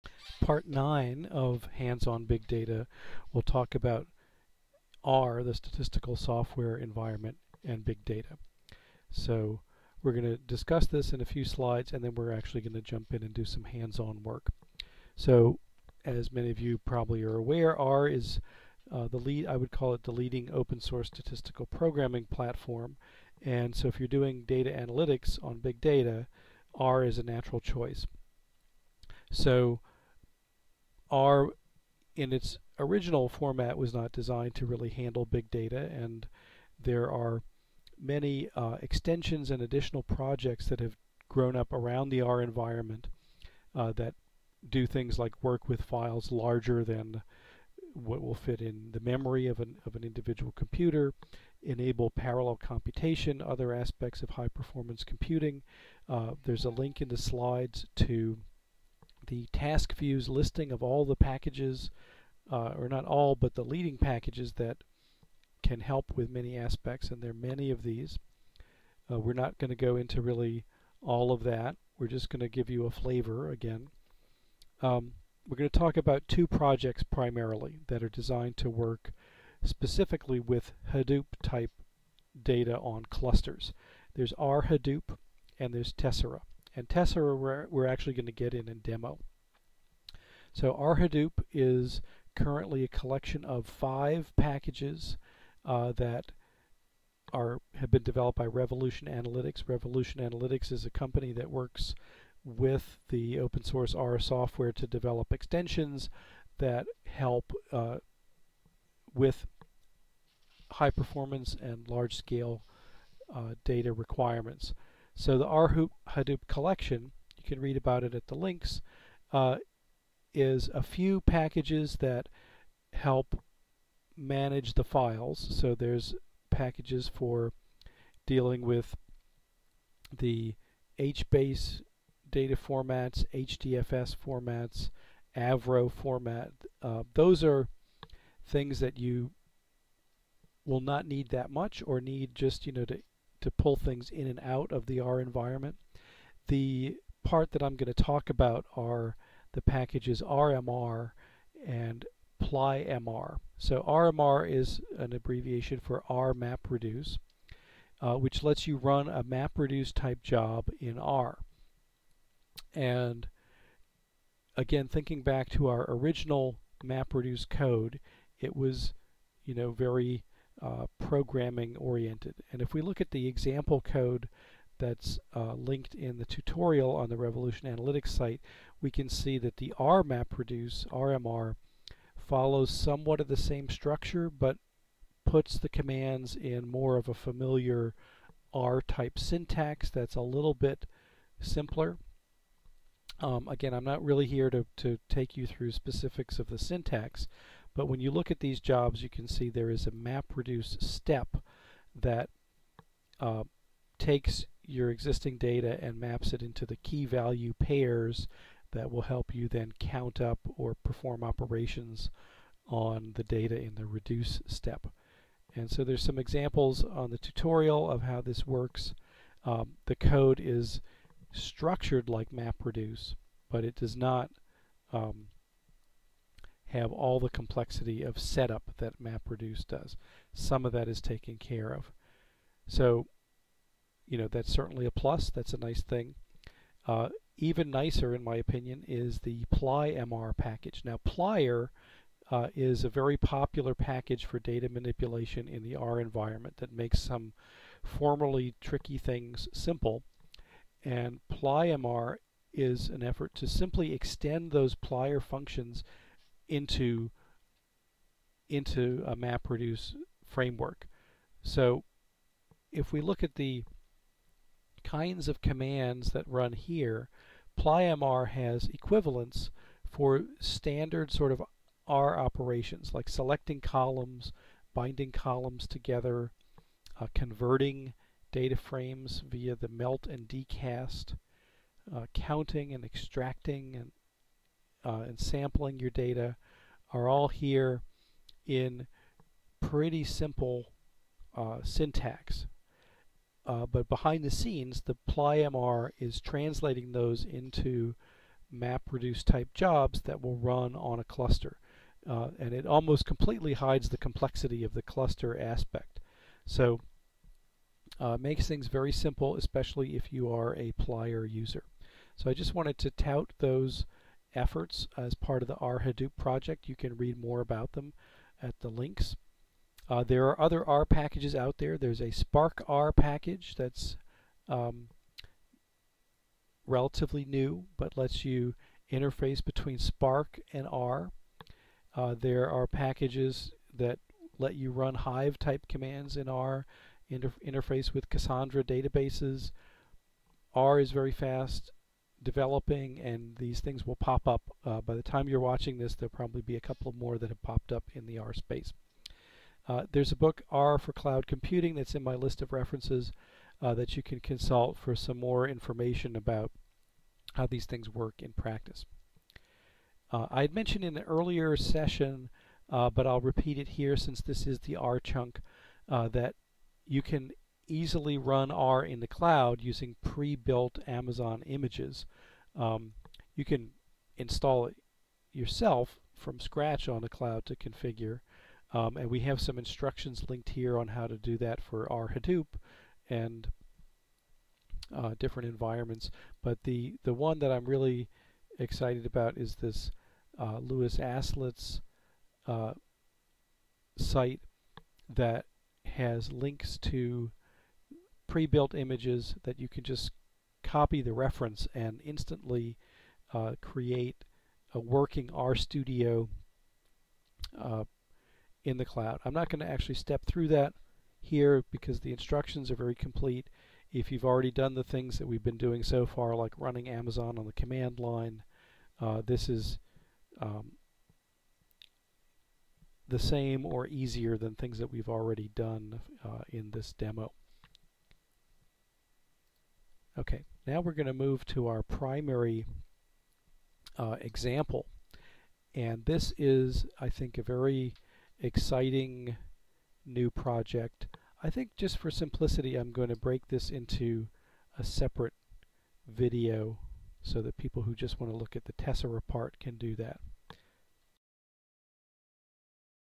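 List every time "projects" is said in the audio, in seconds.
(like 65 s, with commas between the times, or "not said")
40 s, 76 s, 316 s, 440 s.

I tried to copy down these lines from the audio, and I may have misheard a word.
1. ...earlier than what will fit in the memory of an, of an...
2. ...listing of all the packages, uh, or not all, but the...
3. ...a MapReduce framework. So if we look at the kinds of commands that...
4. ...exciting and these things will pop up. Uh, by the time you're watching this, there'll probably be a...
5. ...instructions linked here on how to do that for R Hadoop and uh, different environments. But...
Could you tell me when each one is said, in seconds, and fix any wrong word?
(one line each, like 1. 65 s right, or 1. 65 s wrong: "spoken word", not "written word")
1. 46 s wrong: "larger", not "earlier"
2. 60 s right
3. 259 s right
4. 342 s wrong: "developing", not "exciting"
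5. 379 s right.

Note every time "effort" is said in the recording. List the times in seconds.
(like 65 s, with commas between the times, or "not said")
253 s, 314 s.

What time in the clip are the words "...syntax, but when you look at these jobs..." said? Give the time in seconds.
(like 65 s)
196 s.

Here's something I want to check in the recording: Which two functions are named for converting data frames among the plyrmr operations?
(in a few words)
melt and dcast.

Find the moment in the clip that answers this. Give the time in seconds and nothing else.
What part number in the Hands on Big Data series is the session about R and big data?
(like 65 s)
0 s.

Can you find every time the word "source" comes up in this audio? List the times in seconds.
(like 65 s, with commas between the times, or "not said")
20 s, 103 s.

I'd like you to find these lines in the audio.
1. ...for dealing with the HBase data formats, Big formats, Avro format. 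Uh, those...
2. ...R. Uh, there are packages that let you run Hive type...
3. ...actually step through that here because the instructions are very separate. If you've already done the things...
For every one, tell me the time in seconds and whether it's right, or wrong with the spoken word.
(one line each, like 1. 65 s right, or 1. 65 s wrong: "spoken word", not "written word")
1. 127 s wrong: "HDFS", not "Big"
2. 330 s right
3. 409 s wrong: "complete", not "separate".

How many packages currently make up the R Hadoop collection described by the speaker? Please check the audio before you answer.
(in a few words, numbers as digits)
5.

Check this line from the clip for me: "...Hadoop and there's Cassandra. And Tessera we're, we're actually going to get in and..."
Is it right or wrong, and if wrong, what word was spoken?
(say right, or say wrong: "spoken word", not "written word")
wrong: "Tessera", not "Cassandra".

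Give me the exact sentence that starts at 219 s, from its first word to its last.
Um, the code is structured like MapReduce, but it does not um, have all the complexity of setup that MapReduce does.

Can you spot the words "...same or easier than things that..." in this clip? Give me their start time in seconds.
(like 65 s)
423 s.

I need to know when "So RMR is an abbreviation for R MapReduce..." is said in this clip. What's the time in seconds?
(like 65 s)
153 s.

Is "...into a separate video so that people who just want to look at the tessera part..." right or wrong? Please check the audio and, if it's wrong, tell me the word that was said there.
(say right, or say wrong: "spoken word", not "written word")
right.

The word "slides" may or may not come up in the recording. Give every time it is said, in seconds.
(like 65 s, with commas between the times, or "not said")
11 s, 57 s.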